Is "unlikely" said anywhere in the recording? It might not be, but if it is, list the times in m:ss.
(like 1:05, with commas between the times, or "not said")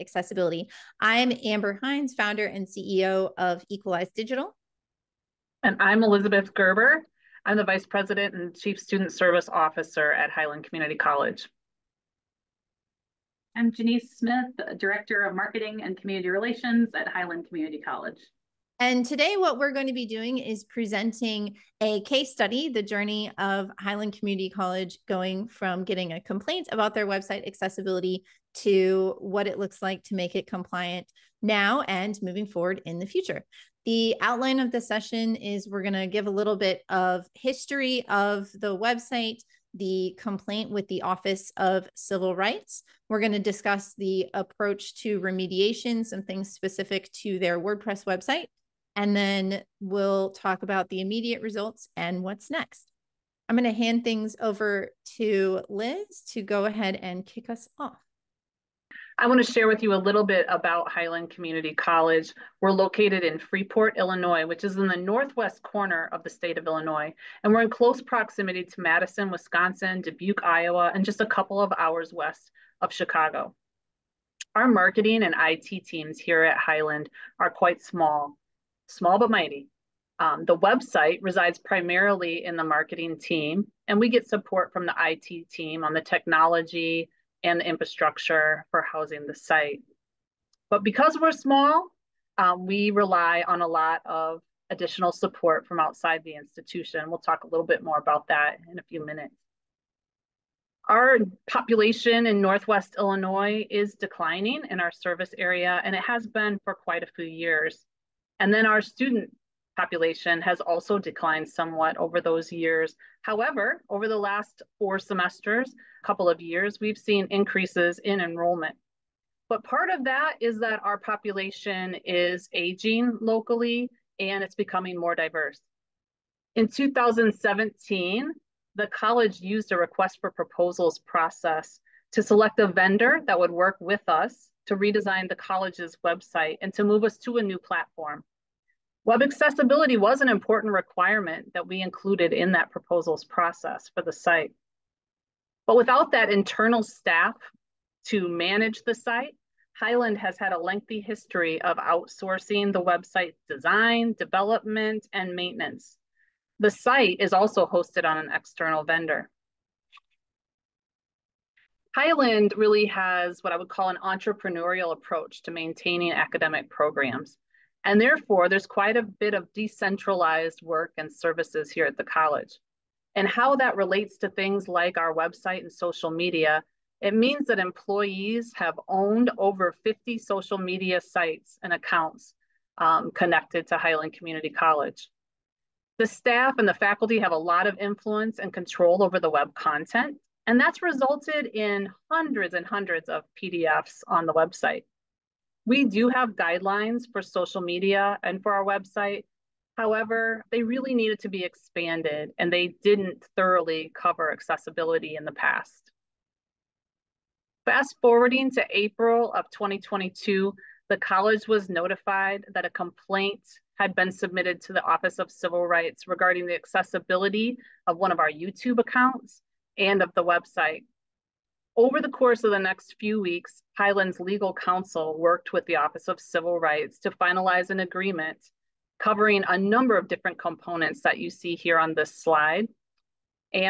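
not said.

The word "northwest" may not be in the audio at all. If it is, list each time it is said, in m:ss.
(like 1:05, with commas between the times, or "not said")
1:04, 1:42.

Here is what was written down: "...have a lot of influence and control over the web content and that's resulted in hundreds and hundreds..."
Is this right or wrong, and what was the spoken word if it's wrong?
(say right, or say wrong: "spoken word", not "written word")
right.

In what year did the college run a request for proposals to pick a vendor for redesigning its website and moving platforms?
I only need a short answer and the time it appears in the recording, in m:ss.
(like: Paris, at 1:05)
2017, at 2:06.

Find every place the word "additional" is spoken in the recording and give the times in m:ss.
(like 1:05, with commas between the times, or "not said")
1:34.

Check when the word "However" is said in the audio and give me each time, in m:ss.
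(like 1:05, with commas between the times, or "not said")
1:53, 3:19.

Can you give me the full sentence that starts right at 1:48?
And then our student population has also declined somewhat over those years.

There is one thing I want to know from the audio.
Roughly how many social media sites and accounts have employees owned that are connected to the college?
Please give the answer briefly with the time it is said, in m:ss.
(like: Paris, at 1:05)
Over 50, at 2:59.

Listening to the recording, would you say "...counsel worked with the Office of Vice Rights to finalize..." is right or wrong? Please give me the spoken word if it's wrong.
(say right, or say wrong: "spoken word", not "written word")
wrong: "Civil", not "Vice".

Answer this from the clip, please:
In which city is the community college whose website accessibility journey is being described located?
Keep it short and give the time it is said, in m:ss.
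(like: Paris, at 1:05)
Freeport, Illinois, at 1:03.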